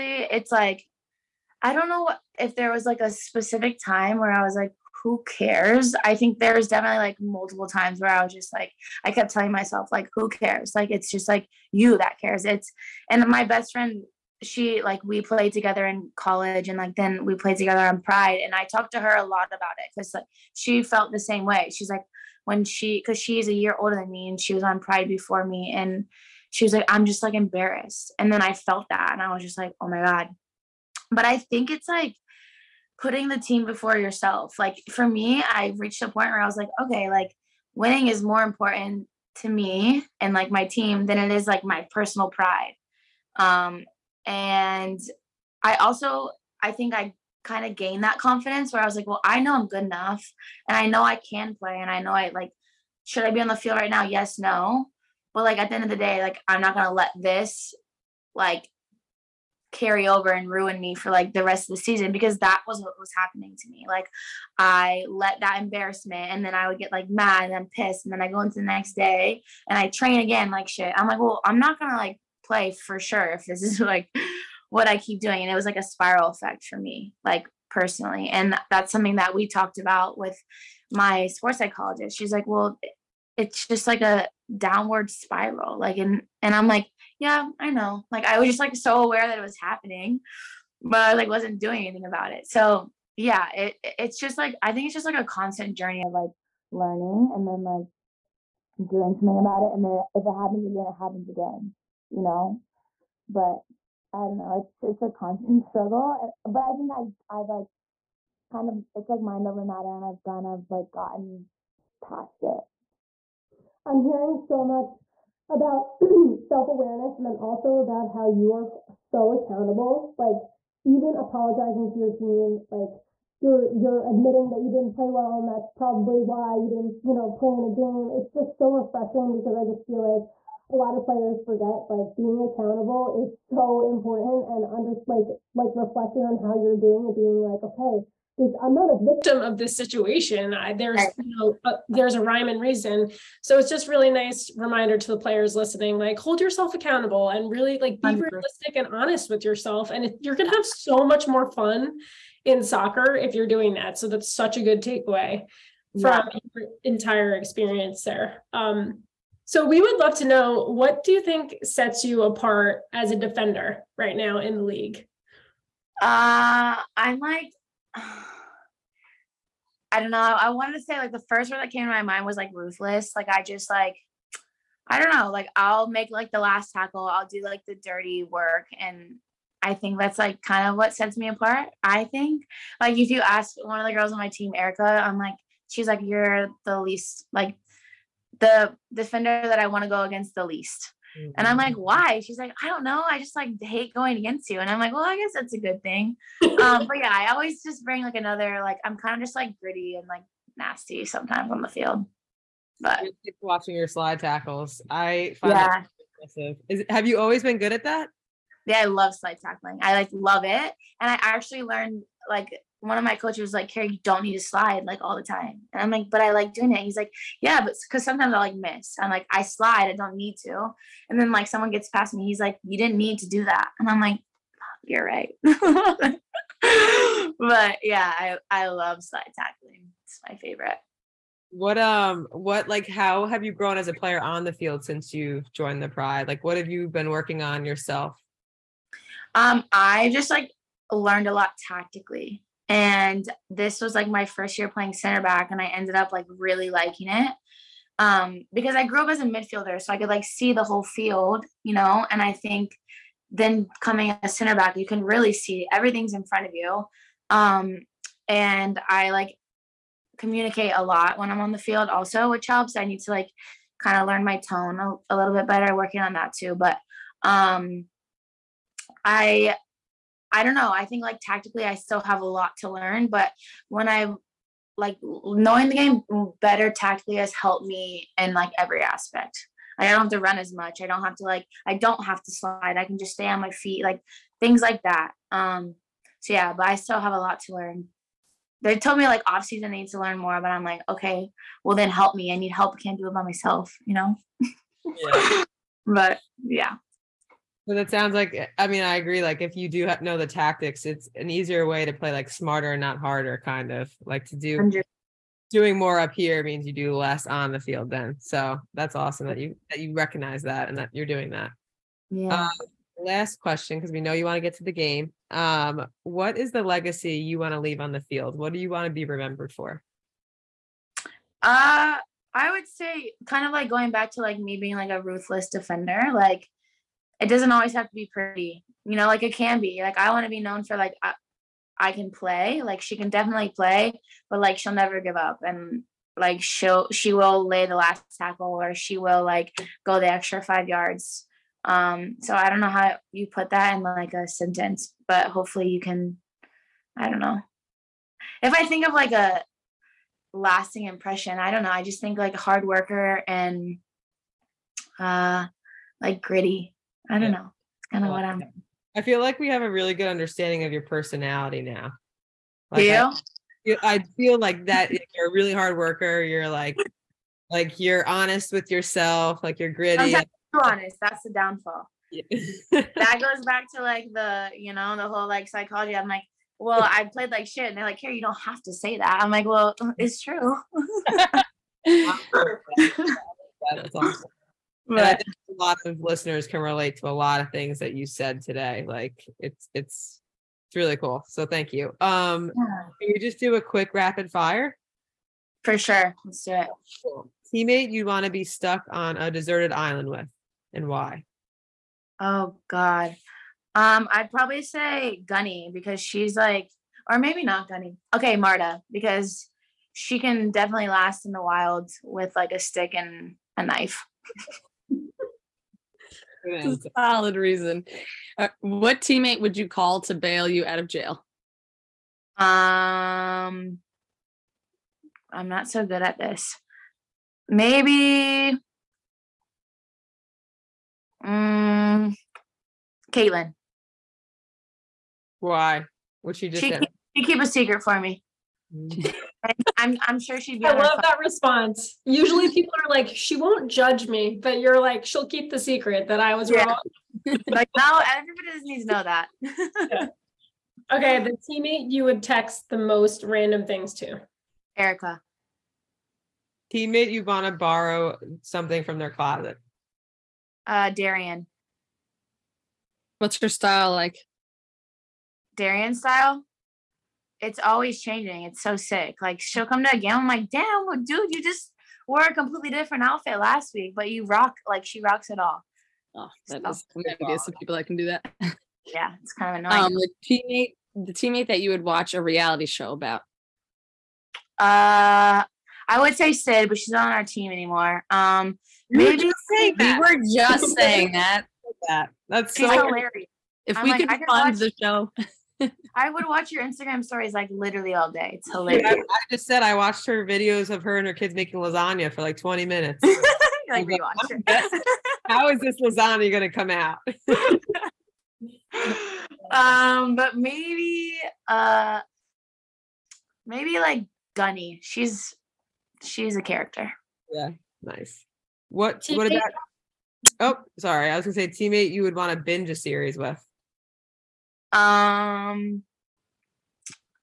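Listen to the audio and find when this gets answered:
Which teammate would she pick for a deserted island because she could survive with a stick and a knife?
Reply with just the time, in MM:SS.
06:48.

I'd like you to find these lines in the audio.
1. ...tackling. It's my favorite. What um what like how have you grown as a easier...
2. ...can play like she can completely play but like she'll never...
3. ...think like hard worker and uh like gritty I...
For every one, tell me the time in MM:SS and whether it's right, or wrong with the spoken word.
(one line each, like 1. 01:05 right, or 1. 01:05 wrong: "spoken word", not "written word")
1. 03:49 wrong: "player", not "easier"
2. 05:31 wrong: "definitely", not "completely"
3. 05:52 right.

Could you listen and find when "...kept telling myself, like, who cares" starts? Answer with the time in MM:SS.
00:09.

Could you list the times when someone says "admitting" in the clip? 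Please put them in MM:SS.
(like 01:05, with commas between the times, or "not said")
02:04.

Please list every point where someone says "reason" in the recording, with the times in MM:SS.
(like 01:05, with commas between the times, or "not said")
02:22, 06:57.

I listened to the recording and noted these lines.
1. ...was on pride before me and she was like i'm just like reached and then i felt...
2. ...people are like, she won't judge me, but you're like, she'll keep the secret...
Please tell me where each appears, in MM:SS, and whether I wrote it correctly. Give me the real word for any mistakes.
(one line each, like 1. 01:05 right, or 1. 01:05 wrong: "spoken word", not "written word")
1. 00:24 wrong: "embarrassed", not "reached"
2. 07:22 right.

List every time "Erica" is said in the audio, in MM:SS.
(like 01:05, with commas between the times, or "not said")
03:04, 07:34.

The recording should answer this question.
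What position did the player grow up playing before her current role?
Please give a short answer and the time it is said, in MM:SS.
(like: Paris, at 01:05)
Midfielder, at 04:09.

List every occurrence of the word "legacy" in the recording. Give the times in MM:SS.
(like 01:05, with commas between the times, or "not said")
05:16.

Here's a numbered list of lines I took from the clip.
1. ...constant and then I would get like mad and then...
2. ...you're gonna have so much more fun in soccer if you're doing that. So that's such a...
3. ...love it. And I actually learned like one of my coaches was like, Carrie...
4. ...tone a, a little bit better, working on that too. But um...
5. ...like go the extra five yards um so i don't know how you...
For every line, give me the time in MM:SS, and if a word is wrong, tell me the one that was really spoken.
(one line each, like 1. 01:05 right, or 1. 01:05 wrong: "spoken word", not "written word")
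1. 01:05 wrong: "embarrassment", not "constant"
2. 02:30 right
3. 03:30 right
4. 04:24 right
5. 05:39 right.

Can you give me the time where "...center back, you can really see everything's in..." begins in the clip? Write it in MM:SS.
04:14.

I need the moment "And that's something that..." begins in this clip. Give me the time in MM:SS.
01:18.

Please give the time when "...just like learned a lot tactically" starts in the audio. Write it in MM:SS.
04:00.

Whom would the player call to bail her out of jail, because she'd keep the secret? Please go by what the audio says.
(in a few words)
Caitlin.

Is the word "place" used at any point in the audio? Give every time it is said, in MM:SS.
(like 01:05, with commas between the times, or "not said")
not said.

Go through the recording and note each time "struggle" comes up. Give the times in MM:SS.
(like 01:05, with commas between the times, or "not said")
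01:45.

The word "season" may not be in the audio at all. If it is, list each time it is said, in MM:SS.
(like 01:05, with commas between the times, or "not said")
01:01, 04:49.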